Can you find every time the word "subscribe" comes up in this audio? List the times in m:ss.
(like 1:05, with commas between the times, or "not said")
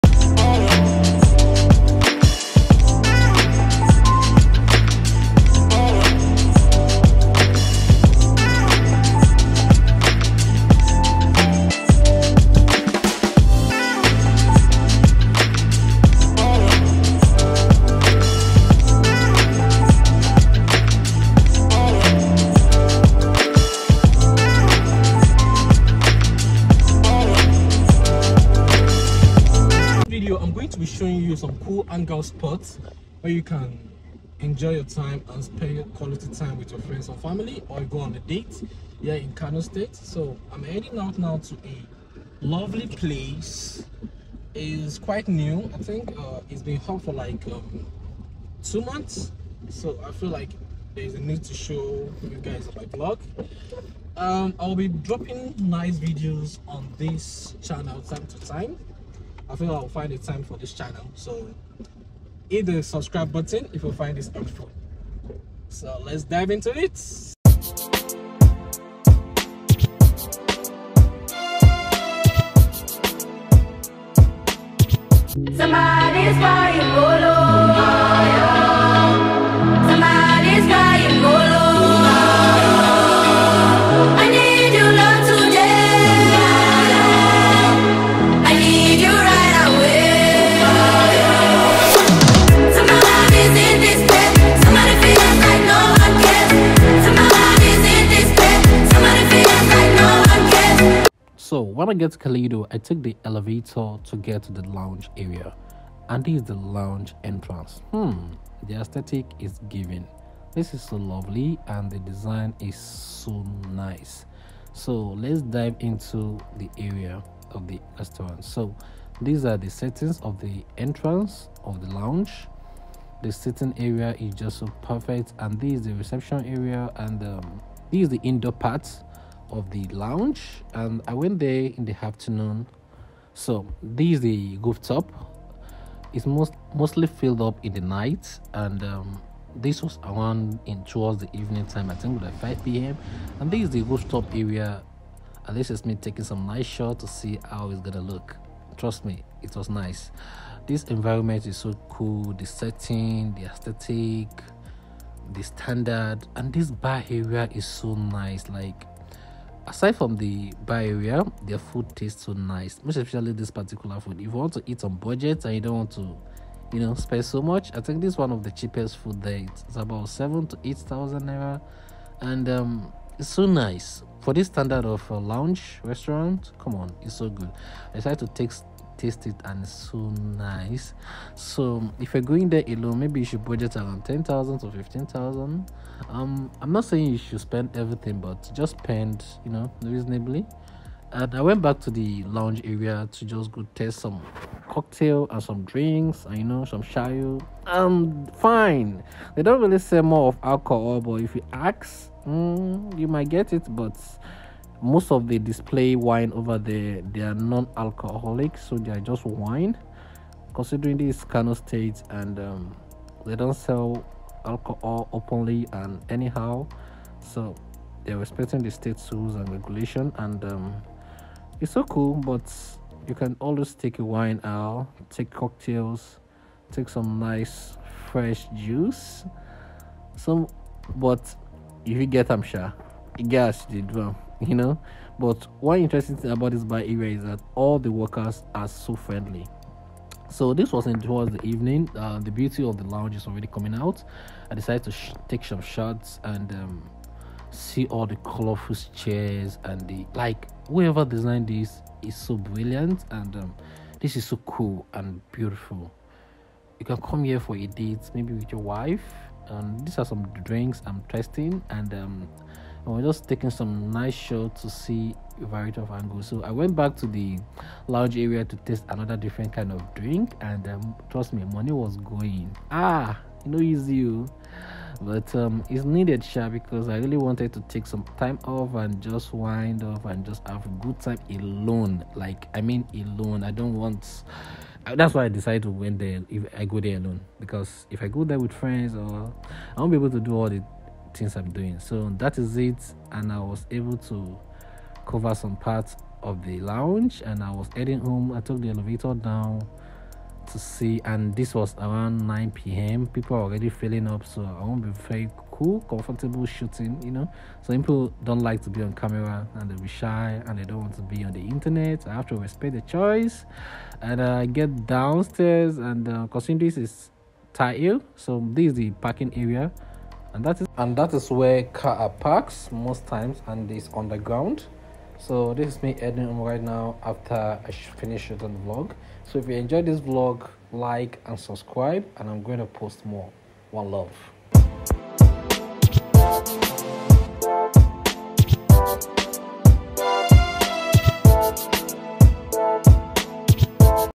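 1:02, 5:31.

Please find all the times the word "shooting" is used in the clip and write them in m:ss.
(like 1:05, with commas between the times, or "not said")
5:06.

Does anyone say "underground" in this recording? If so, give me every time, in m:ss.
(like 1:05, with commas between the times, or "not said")
5:23.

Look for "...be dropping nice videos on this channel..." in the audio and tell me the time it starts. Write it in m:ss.
0:54.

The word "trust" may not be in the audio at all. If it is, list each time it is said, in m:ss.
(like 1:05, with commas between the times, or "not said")
2:28, 4:31.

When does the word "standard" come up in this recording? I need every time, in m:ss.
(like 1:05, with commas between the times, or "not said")
2:35, 2:54.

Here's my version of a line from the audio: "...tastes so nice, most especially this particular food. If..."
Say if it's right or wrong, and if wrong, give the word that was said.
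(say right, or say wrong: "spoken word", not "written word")
right.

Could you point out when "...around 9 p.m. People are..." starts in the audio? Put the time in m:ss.
5:01.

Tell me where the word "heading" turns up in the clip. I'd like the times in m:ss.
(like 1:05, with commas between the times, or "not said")
0:40, 4:57.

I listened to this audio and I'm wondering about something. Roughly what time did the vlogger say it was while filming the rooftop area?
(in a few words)
5 p.m.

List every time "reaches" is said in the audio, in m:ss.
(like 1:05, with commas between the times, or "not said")
not said.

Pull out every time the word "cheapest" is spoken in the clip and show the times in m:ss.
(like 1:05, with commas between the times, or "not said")
2:48.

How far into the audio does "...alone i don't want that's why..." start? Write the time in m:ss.
4:42.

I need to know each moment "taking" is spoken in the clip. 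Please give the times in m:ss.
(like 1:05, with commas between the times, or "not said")
2:25, 4:23.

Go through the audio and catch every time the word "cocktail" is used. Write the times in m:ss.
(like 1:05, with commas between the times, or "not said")
3:14, 3:45.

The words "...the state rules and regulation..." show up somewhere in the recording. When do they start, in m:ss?
3:38.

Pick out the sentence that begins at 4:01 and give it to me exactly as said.
Uh, the beauty of the lounge is already coming out.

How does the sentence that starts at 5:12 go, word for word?
I have to respect the choice.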